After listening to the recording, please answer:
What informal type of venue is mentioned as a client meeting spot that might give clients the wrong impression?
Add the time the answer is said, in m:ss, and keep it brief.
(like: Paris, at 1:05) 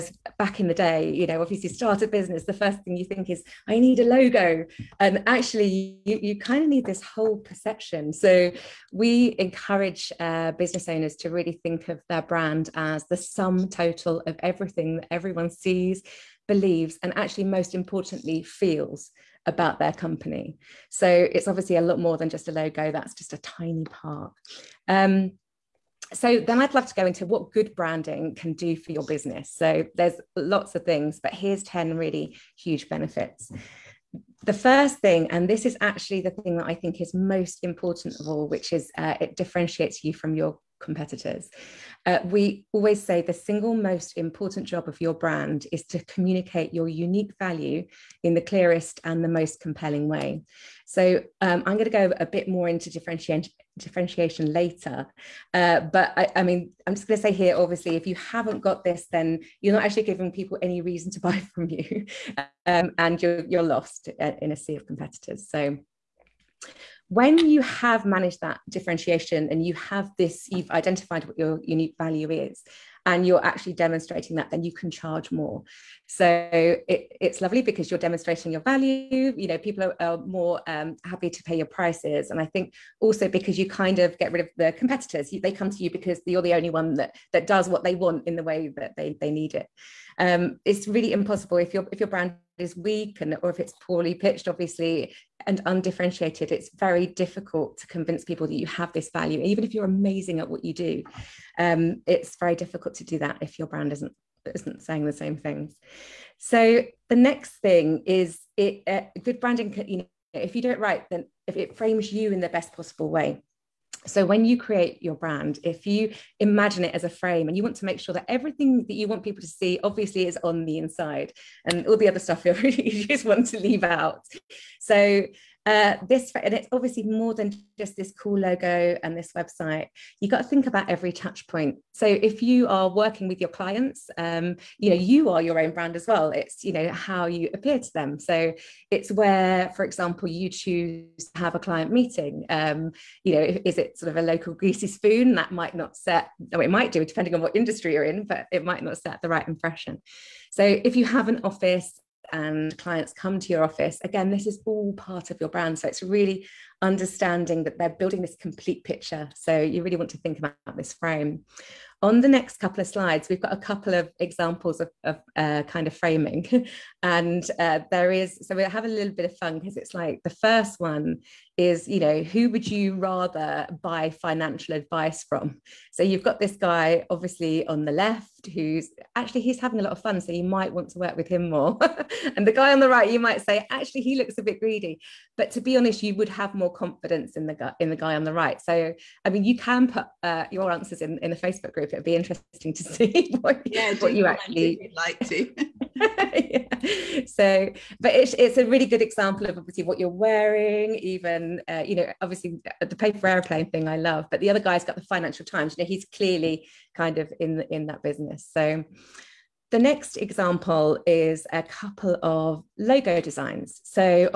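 Local greasy spoon, at 2:24.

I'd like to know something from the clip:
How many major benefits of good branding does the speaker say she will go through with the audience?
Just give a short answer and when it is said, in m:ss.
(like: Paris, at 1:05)
10, at 0:31.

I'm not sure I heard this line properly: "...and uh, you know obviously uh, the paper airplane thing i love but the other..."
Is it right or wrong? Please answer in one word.
right.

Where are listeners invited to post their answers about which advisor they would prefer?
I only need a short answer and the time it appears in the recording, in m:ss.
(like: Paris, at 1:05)
The Facebook group, at 3:11.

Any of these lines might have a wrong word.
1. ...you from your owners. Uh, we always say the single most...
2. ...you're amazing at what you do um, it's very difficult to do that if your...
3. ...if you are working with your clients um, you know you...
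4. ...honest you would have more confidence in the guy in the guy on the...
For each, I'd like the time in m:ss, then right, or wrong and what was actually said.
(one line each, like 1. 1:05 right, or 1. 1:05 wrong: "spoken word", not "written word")
1. 0:40 wrong: "competitors", not "owners"
2. 1:39 right
3. 2:12 right
4. 3:05 right.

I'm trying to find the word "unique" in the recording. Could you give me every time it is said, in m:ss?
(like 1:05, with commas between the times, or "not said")
0:46, 1:11.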